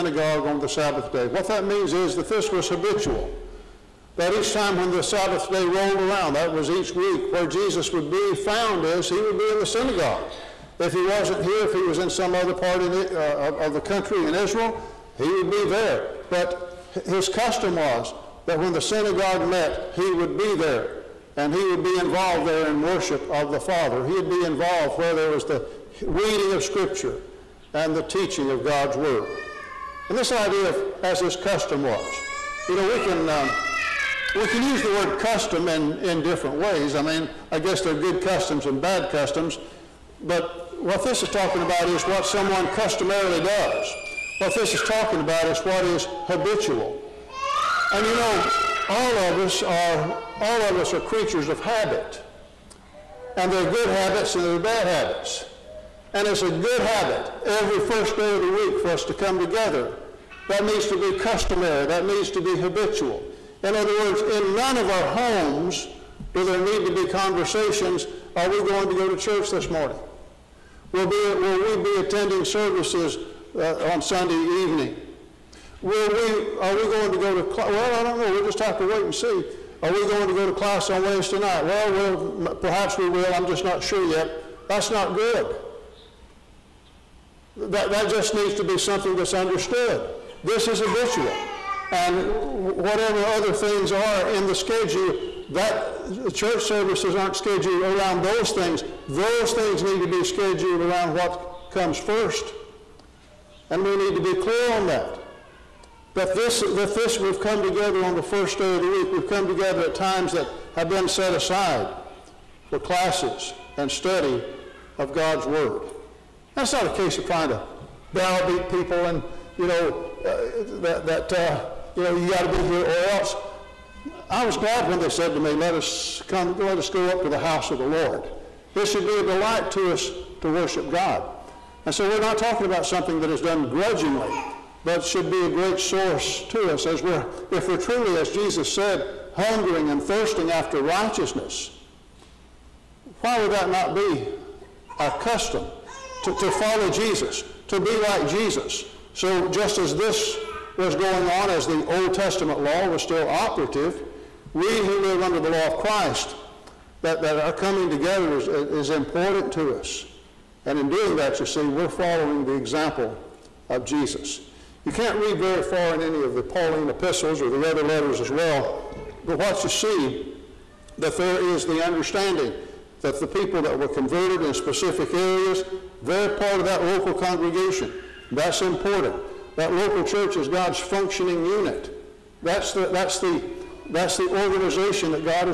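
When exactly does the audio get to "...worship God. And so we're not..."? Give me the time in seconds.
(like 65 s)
130 s.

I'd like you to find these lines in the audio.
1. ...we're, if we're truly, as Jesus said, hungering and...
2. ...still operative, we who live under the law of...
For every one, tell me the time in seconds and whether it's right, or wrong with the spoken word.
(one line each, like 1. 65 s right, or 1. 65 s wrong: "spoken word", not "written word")
1. 137 s right
2. 153 s right.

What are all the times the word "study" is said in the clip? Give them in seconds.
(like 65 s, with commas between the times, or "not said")
113 s.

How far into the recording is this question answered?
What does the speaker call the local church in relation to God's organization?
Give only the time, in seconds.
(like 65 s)
180 s.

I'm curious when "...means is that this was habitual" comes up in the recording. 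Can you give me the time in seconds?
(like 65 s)
1 s.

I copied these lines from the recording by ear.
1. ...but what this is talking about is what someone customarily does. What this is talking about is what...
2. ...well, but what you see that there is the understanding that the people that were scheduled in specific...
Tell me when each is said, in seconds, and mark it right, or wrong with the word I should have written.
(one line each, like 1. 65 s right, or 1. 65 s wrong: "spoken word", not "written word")
1. 40 s right
2. 168 s wrong: "converted", not "scheduled".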